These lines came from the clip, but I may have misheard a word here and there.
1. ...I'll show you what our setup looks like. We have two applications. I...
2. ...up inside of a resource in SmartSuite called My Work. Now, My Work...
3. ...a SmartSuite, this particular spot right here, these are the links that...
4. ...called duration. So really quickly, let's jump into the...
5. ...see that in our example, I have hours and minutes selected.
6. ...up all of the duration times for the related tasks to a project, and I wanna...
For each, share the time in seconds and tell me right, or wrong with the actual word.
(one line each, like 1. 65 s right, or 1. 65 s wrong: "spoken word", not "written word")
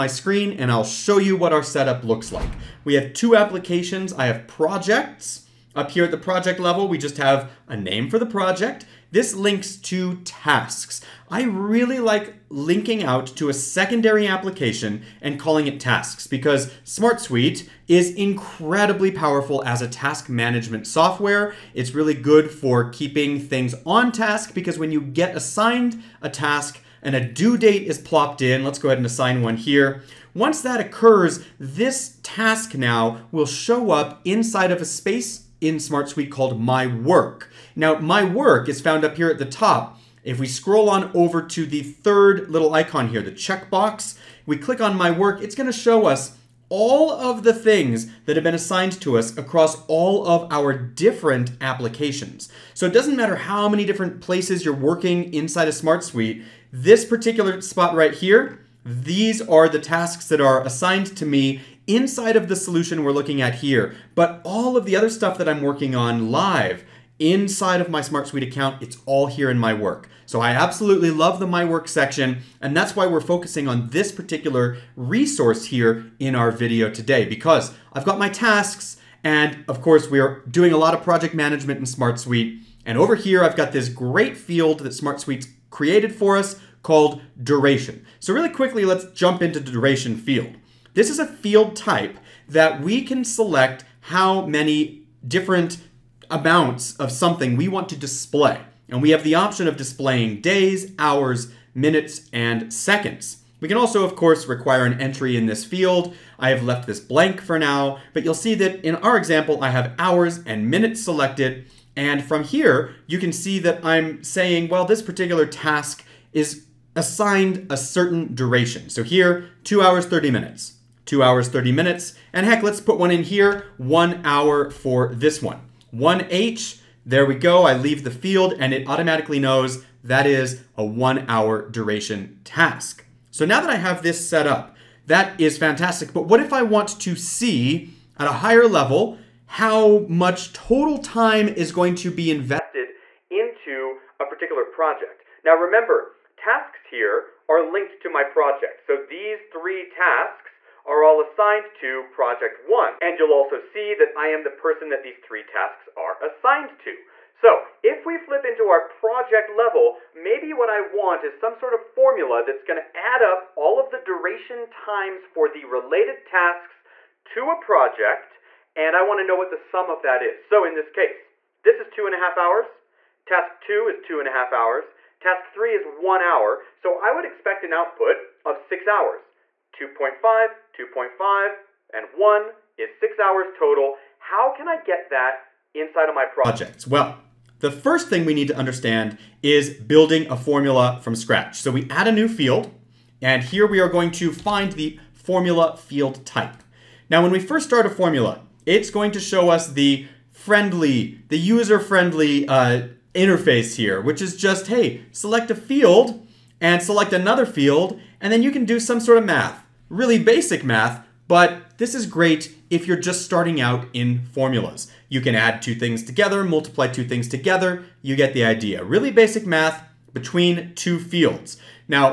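1. 0 s right
2. 33 s wrong: "space", not "resource"
3. 55 s wrong: "tasks", not "links"
4. 86 s right
5. 108 s right
6. 163 s right.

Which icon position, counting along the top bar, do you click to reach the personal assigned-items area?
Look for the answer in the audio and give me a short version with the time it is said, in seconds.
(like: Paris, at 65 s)
third, at 41 s.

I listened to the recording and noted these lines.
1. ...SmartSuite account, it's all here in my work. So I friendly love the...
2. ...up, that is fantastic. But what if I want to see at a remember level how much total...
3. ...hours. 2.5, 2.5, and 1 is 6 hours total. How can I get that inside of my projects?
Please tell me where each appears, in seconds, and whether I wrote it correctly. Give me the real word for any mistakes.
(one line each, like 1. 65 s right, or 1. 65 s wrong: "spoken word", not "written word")
1. 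68 s wrong: "absolutely", not "friendly"
2. 134 s wrong: "higher", not "remember"
3. 178 s right.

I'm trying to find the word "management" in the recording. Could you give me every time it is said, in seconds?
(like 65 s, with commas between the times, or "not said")
20 s, 81 s.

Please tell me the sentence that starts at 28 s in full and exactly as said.
Let's go ahead and assign one here.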